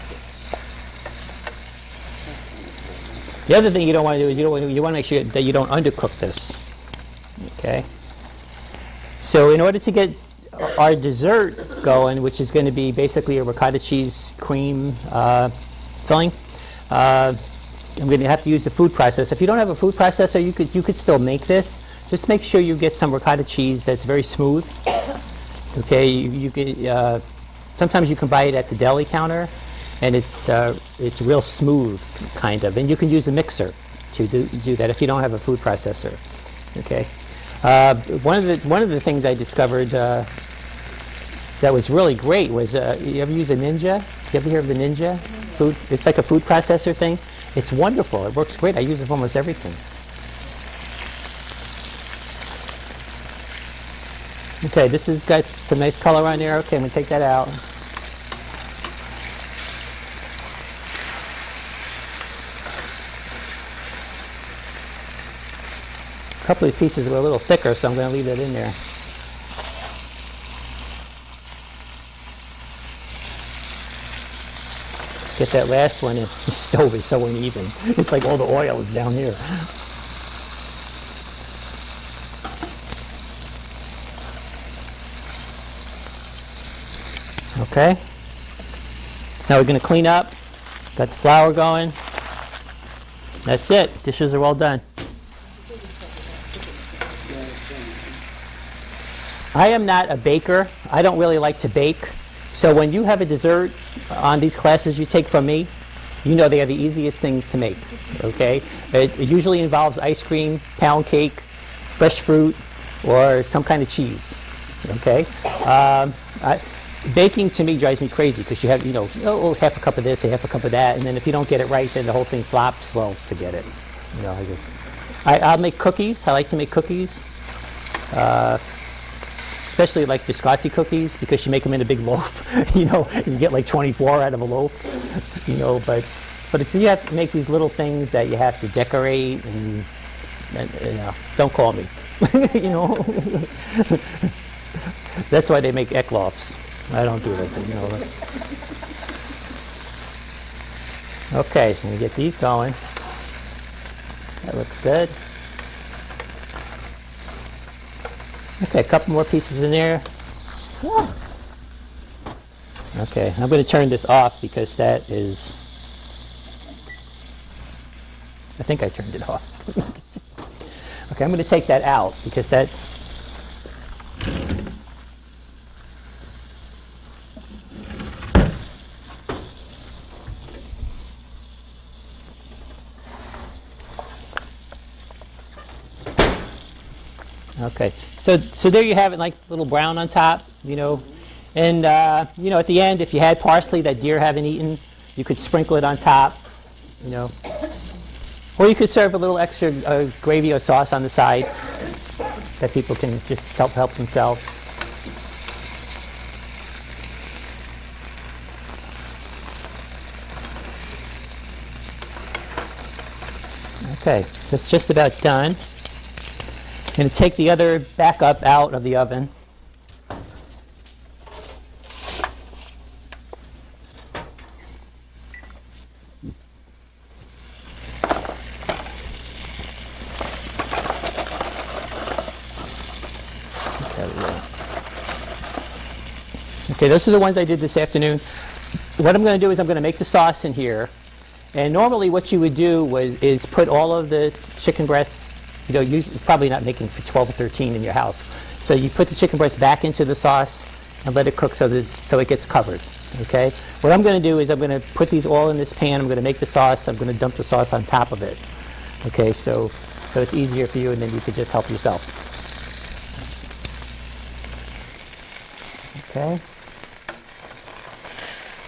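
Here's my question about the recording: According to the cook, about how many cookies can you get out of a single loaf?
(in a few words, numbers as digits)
24.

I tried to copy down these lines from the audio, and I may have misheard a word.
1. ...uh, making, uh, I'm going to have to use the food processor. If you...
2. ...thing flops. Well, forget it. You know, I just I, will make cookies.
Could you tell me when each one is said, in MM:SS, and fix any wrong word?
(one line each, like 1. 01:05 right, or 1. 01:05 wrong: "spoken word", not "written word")
1. 00:15 wrong: "filling", not "making"
2. 02:02 right.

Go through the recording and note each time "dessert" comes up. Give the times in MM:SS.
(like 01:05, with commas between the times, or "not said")
00:10, 01:43.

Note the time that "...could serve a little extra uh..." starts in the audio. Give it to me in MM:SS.
03:18.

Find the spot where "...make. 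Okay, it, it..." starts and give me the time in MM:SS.
01:47.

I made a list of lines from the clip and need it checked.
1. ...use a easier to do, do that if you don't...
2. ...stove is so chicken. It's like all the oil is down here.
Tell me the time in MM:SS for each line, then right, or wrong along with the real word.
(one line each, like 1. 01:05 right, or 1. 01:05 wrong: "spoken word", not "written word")
1. 00:33 wrong: "mixer", not "easier"
2. 01:16 wrong: "uneven", not "chicken".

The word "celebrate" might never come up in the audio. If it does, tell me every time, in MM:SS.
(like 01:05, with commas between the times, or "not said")
not said.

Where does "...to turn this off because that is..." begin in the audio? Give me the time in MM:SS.
02:43.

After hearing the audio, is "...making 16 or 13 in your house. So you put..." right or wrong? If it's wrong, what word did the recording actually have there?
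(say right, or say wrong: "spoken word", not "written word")
wrong: "12", not "16".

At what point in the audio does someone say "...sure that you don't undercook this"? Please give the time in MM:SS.
00:05.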